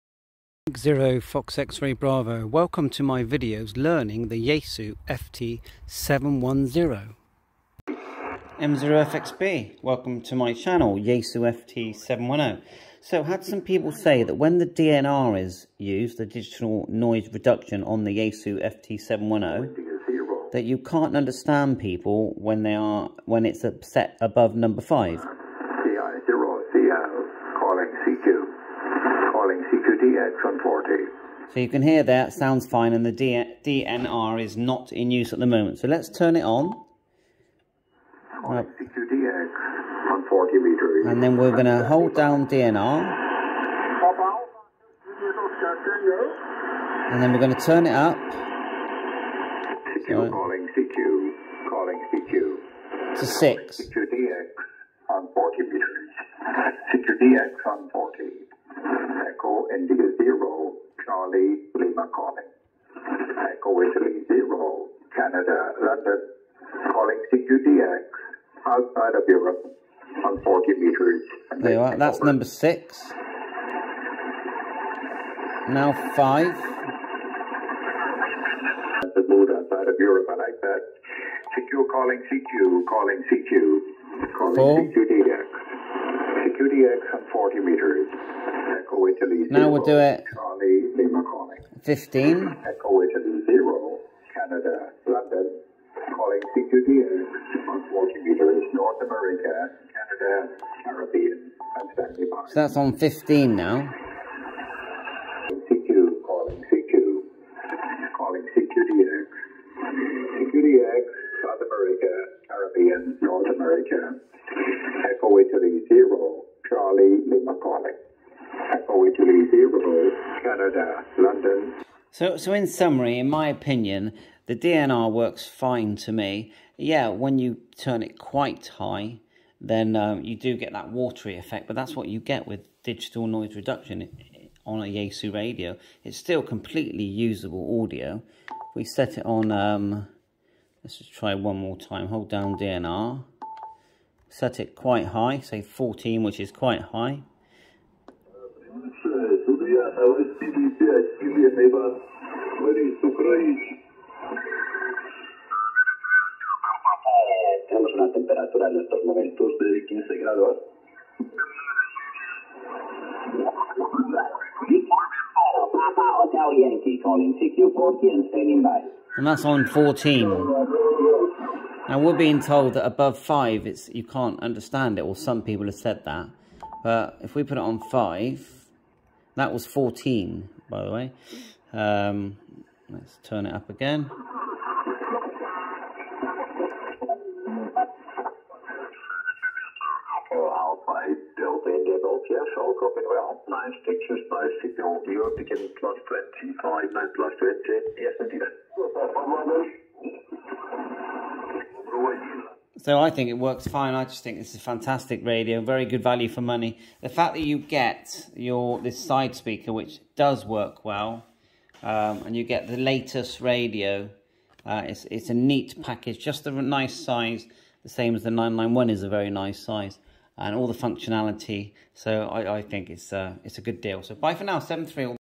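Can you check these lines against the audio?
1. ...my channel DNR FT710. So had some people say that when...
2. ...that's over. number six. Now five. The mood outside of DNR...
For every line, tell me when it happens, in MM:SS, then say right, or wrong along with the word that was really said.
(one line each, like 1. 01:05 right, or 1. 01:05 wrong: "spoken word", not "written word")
1. 00:10 wrong: "Yaesu", not "DNR"
2. 01:11 wrong: "Europe", not "DNR".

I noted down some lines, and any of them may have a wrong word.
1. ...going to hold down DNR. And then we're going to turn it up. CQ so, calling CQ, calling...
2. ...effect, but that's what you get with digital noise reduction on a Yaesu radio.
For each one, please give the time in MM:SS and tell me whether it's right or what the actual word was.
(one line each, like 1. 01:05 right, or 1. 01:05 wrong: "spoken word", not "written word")
1. 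00:41 right
2. 02:11 right.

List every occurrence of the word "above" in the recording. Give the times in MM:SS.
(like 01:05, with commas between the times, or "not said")
00:24, 02:52.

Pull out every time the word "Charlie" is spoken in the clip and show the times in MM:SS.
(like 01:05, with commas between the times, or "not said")
01:30, 01:56.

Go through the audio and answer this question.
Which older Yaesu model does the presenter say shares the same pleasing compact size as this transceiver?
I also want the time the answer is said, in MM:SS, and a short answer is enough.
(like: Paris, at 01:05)
991, at 03:38.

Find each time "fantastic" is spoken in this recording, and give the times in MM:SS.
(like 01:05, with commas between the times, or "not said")
03:24.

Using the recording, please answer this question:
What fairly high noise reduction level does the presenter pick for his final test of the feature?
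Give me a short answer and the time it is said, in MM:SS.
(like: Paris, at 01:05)
14, at 02:25.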